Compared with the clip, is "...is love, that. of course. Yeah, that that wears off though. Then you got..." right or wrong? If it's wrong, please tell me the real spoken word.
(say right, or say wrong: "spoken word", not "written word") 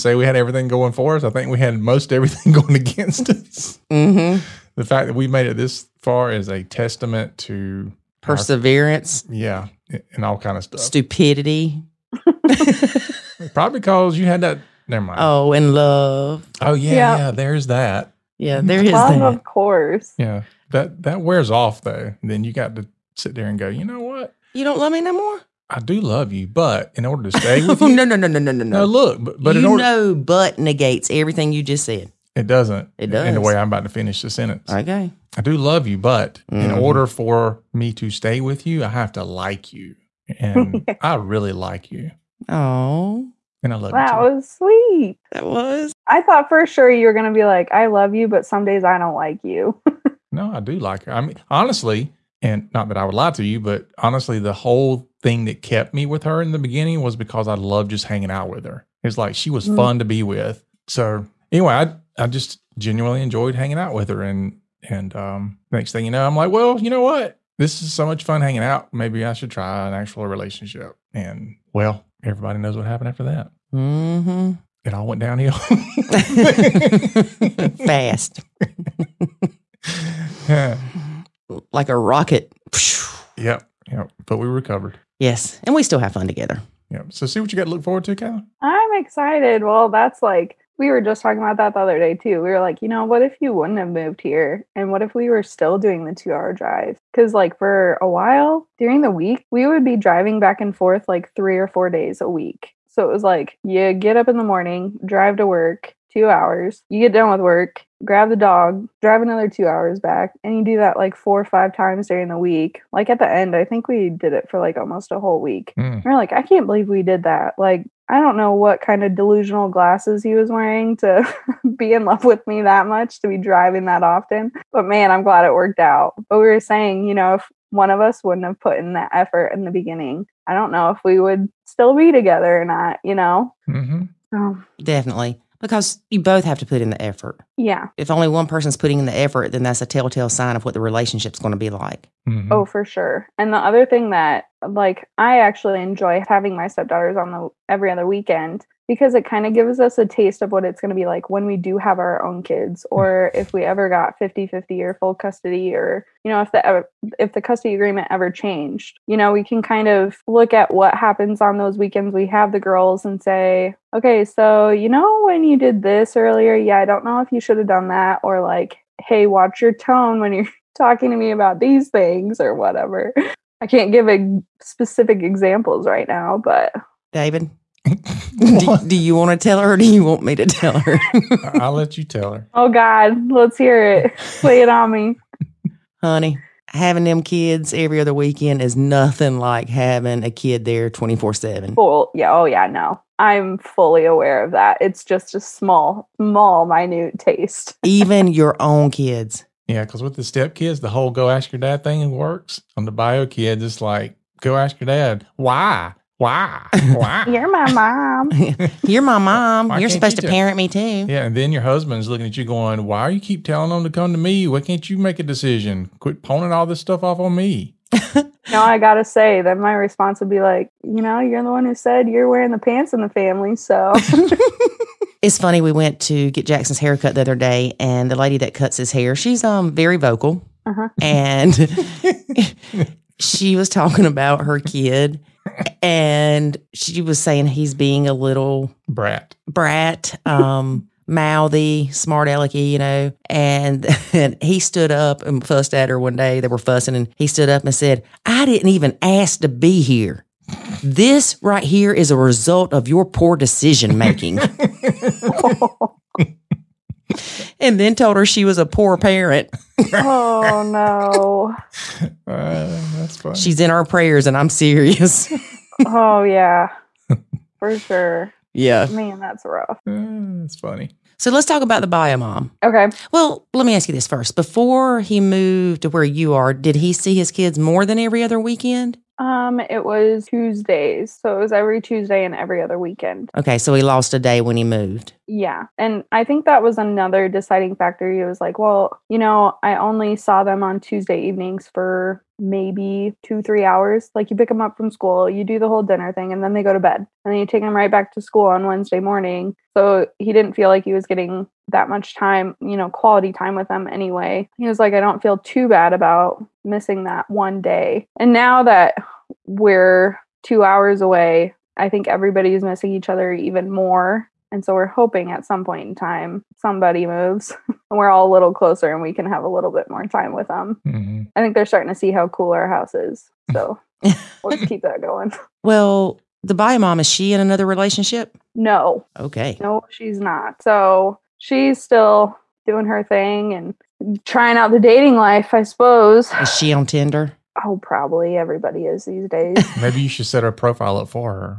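right.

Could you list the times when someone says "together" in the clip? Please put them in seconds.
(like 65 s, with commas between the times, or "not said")
86 s, 132 s.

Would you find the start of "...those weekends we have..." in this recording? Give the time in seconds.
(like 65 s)
161 s.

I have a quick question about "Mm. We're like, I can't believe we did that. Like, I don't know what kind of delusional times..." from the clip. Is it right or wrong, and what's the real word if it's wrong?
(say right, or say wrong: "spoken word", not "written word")
wrong: "glasses", not "times".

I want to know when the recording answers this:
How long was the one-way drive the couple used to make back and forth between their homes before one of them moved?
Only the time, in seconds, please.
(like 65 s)
96 s.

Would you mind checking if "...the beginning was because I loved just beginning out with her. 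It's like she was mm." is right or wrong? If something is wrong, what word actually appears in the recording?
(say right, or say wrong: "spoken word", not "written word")
wrong: "hanging", not "beginning".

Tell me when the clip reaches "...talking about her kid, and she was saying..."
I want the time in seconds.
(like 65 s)
233 s.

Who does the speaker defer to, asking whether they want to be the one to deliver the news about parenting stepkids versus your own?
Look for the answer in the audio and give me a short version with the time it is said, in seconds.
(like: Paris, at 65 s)
David, at 177 s.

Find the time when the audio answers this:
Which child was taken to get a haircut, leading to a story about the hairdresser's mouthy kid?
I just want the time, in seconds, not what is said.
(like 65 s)
226 s.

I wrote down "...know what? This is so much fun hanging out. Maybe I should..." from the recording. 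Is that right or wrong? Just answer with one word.
right.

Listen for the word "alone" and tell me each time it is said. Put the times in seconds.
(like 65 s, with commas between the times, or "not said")
not said.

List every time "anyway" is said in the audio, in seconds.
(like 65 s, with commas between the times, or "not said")
61 s, 303 s.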